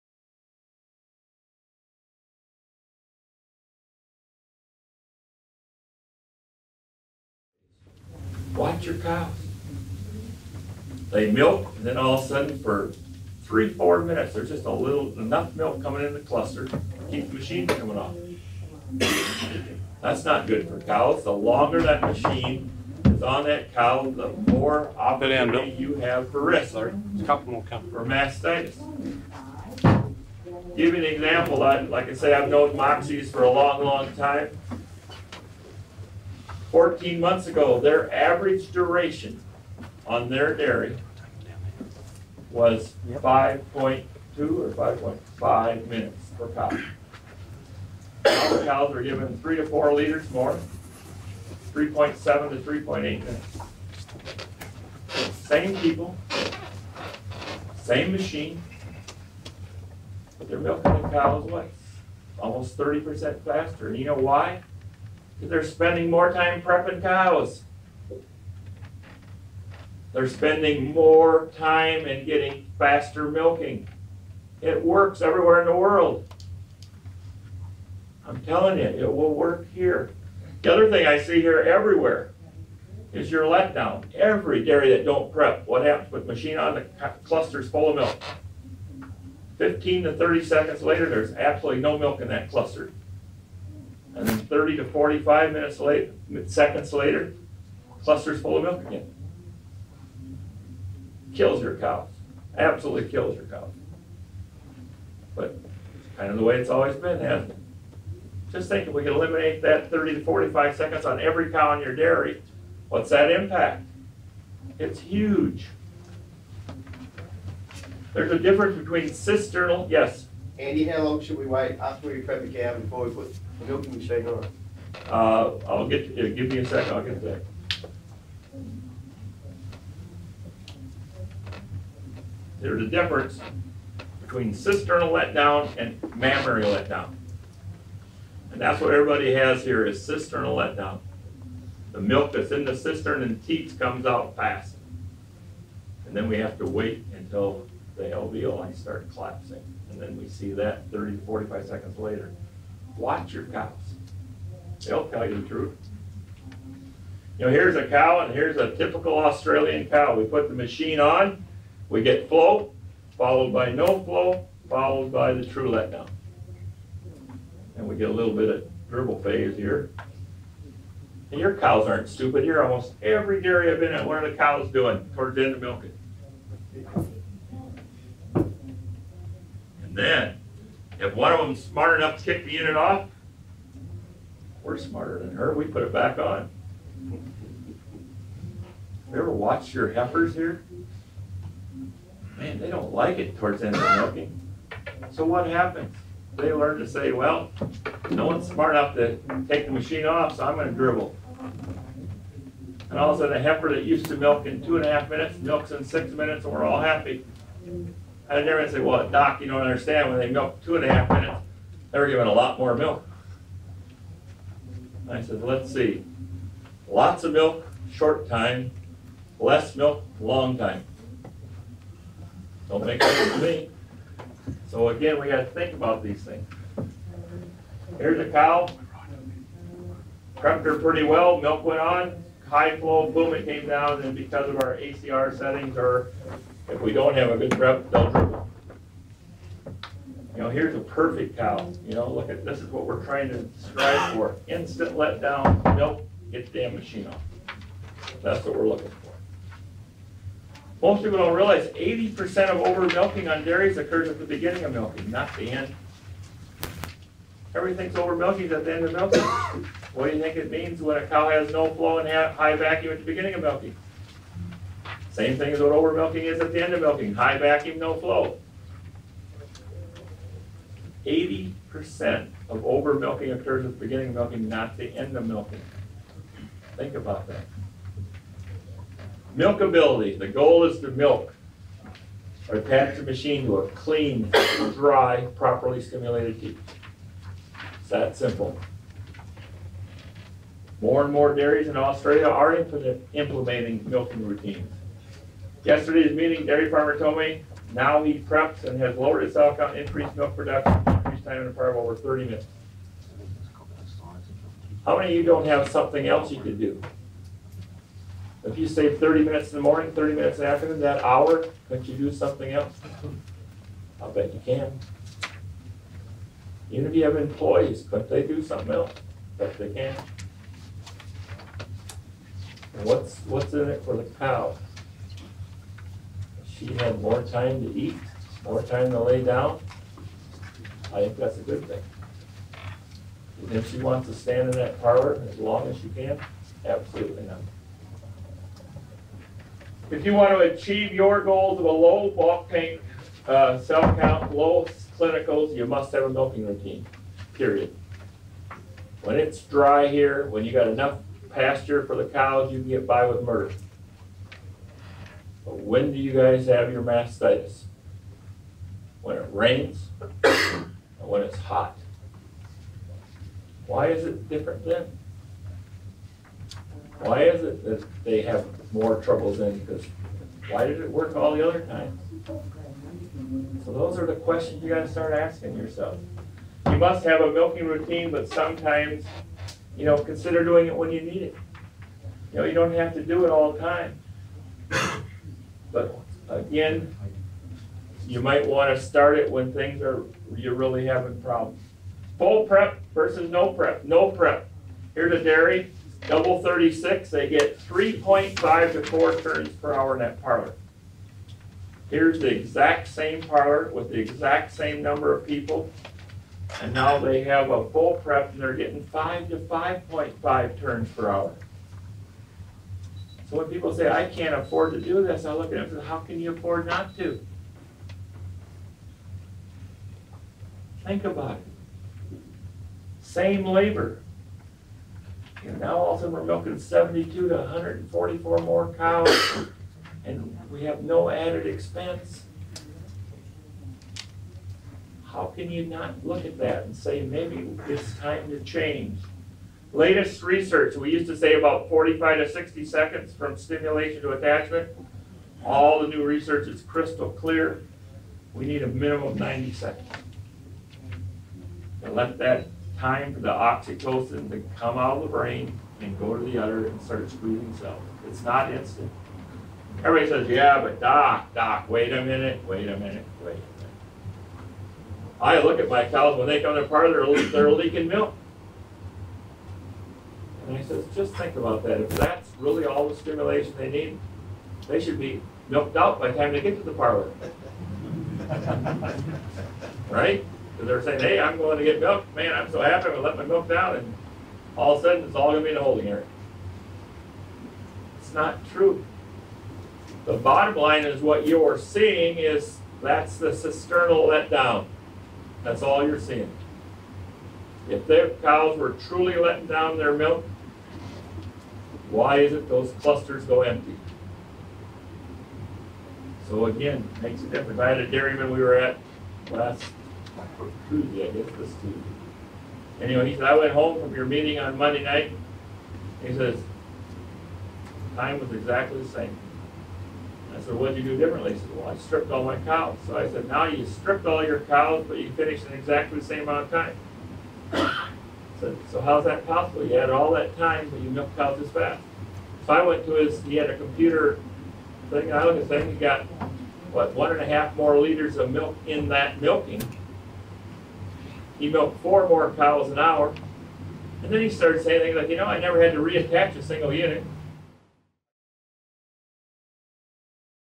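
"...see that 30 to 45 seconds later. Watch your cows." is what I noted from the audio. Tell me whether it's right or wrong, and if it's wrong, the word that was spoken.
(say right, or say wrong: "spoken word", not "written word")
right.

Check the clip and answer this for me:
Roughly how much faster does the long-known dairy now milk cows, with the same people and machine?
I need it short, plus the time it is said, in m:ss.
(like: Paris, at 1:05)
Almost 30%, at 1:02.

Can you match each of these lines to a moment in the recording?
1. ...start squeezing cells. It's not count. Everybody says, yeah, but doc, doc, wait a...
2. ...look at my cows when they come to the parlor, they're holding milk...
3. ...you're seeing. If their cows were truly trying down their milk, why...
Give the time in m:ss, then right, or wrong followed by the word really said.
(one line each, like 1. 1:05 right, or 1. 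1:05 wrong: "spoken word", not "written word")
1. 7:36 wrong: "instant", not "count"
2. 7:45 wrong: "leaking", not "holding"
3. 8:15 wrong: "letting", not "trying".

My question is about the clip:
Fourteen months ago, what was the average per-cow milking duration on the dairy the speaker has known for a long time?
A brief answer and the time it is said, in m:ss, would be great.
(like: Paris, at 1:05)
5.2 or 5.5 minutes, at 0:43.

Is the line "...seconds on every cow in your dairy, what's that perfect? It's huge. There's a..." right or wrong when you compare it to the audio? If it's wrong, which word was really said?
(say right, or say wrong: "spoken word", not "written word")
wrong: "impact", not "perfect".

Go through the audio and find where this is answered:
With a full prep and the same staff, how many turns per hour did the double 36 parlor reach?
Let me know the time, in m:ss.
6:48.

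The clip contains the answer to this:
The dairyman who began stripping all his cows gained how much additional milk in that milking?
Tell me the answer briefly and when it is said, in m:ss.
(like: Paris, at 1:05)
1.5 liters, at 8:56.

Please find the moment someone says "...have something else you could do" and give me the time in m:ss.
5:05.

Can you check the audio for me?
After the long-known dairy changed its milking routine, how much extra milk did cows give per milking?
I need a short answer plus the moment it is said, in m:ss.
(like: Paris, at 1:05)
3 to 4 liters, at 0:49.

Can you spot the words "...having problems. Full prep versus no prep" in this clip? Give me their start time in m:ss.
6:30.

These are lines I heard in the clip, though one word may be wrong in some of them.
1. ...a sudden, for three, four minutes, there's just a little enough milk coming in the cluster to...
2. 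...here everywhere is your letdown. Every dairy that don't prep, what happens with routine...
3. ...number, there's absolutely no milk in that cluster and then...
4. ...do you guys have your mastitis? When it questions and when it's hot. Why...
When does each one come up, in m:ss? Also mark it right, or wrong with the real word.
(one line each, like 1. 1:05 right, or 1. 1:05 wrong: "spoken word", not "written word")
1. 0:12 right
2. 1:21 wrong: "machine", not "routine"
3. 1:30 wrong: "later", not "number"
4. 5:55 wrong: "rains", not "questions".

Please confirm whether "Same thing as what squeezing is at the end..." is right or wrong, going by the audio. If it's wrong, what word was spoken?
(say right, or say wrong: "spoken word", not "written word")
wrong: "overmilking", not "squeezing".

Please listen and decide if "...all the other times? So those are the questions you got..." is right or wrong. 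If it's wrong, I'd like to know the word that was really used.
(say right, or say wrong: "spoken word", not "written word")
right.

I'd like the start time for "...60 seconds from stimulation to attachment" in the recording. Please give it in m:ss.
7:22.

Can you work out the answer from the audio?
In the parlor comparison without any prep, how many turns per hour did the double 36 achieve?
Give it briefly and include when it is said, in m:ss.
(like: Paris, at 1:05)
3.5 to 4, at 6:37.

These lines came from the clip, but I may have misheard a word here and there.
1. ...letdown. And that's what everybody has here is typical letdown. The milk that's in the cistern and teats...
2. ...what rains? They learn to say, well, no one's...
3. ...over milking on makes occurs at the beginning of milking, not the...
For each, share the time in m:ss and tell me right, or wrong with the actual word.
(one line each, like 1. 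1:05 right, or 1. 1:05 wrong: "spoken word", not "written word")
1. 2:16 wrong: "cisternal", not "typical"
2. 3:15 wrong: "happens", not "rains"
3. 4:12 wrong: "dairies", not "makes".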